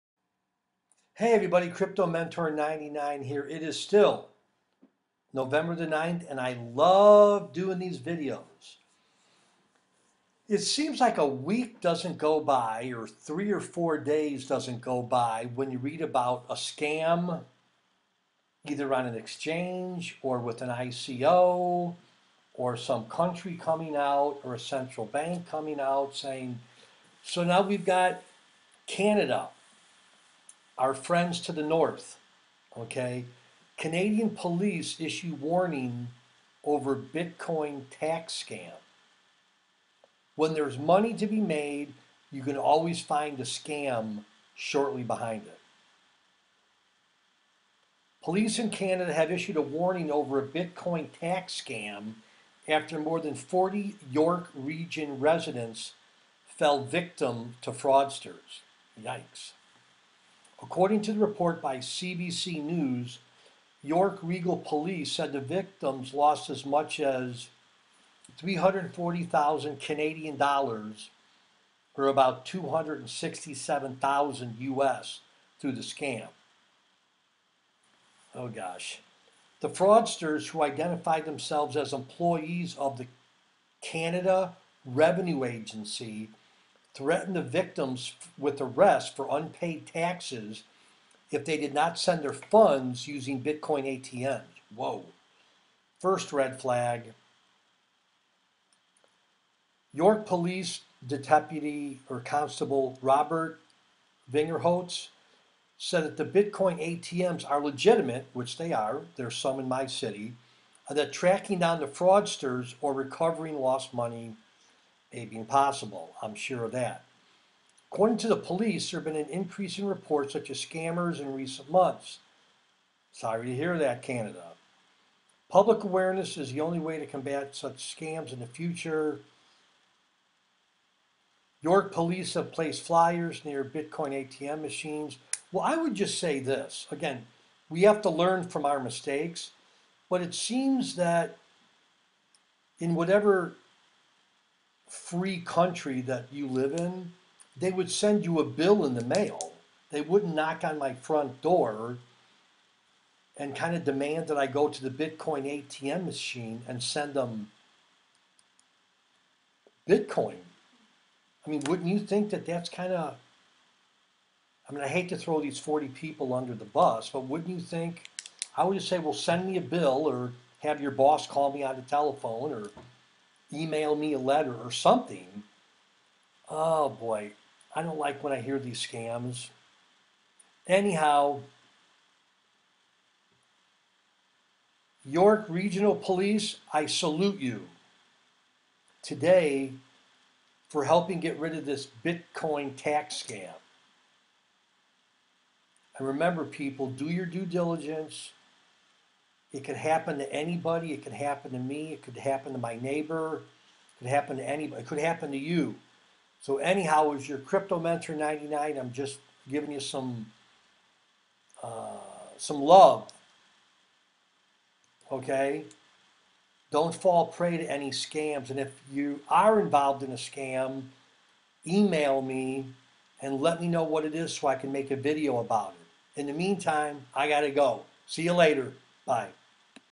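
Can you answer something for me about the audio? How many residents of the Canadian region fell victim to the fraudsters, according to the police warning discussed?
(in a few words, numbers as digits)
more than 40.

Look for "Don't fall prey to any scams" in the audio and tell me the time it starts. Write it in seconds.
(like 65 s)
216 s.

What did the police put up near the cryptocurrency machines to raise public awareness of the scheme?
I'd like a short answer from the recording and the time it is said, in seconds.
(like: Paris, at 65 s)
flyers, at 132 s.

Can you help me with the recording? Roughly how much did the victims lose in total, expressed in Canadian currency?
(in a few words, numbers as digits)
340,000 Canadian dollars.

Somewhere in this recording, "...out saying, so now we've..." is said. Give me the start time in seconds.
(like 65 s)
25 s.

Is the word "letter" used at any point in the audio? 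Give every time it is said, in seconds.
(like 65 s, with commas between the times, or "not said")
174 s.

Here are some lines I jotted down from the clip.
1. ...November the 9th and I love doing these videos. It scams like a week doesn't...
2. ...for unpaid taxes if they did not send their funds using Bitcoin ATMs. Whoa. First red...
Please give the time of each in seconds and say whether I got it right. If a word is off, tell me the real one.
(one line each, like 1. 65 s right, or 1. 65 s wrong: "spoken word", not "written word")
1. 5 s wrong: "seems", not "scams"
2. 89 s right.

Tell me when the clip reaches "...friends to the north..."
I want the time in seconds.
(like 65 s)
30 s.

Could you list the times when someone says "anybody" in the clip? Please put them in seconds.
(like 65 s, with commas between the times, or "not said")
200 s, 204 s.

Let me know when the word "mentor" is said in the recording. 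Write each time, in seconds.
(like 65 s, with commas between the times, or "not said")
2 s, 207 s.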